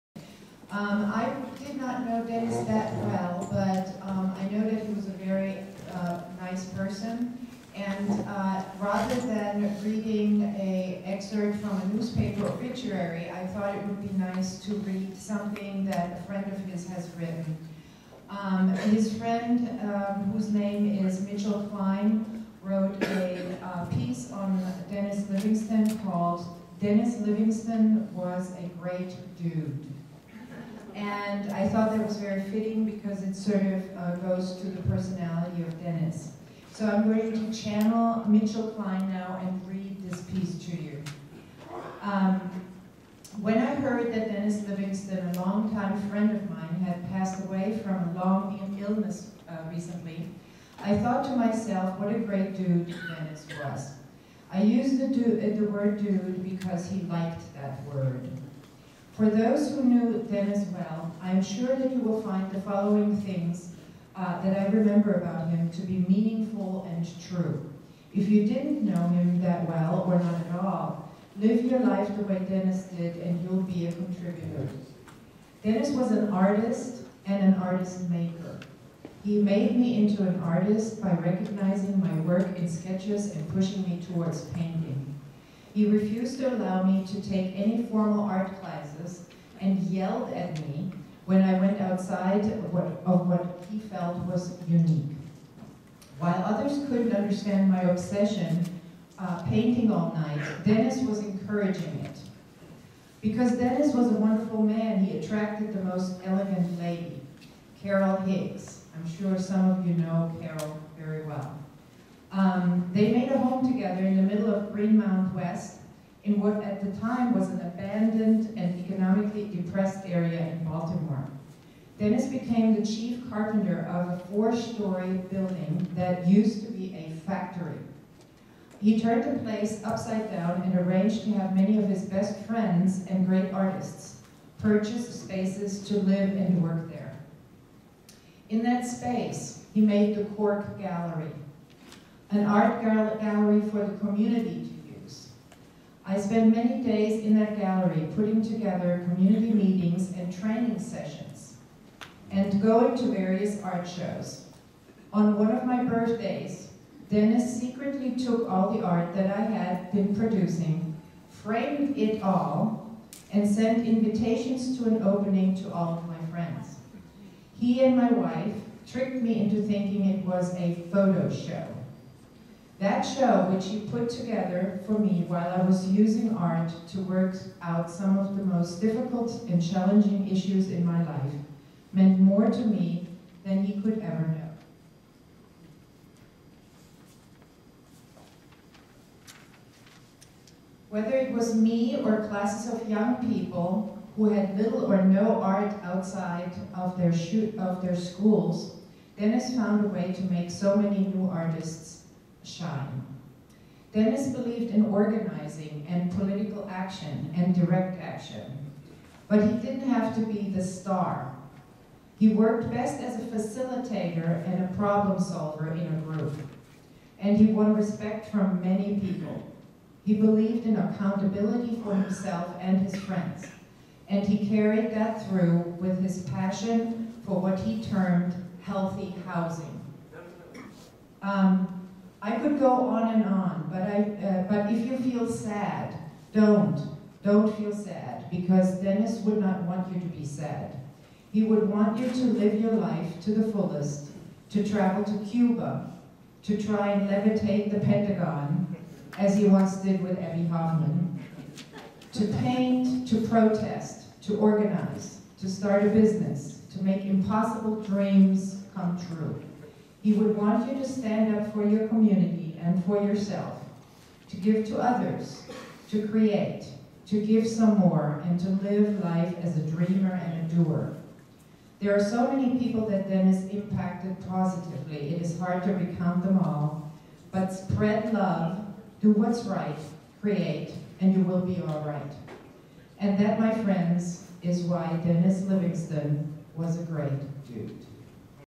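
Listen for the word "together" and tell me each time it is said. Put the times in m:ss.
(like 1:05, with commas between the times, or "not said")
1:53, 2:28, 2:54.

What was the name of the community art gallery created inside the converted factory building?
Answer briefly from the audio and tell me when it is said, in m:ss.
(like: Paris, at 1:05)
Cork Gallery, at 2:20.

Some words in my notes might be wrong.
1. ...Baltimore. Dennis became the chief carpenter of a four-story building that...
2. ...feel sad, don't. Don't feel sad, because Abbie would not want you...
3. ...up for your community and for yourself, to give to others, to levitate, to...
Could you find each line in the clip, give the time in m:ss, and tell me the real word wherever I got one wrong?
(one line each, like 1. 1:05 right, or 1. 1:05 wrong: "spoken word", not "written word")
1. 2:00 right
2. 3:54 wrong: "Dennis", not "Abbie"
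3. 4:21 wrong: "create", not "levitate".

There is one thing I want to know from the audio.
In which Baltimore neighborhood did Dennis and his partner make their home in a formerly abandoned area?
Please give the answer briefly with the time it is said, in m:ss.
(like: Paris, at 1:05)
Greenmount West, at 1:54.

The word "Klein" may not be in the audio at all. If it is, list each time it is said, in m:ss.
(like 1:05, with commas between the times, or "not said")
0:21, 0:38.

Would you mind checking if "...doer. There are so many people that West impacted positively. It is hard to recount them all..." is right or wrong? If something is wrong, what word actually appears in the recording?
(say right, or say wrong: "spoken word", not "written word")
wrong: "Dennis", not "West".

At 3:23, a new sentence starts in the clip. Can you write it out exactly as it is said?
Dennis believed in organizing and political action and direct action, but he didn't have to be the star.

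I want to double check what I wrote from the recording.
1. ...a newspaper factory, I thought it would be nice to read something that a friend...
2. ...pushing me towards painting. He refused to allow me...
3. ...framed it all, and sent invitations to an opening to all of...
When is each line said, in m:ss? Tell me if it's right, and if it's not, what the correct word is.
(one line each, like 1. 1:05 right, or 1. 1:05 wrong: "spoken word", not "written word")
1. 0:11 wrong: "obituary", not "factory"
2. 1:23 right
3. 2:41 right.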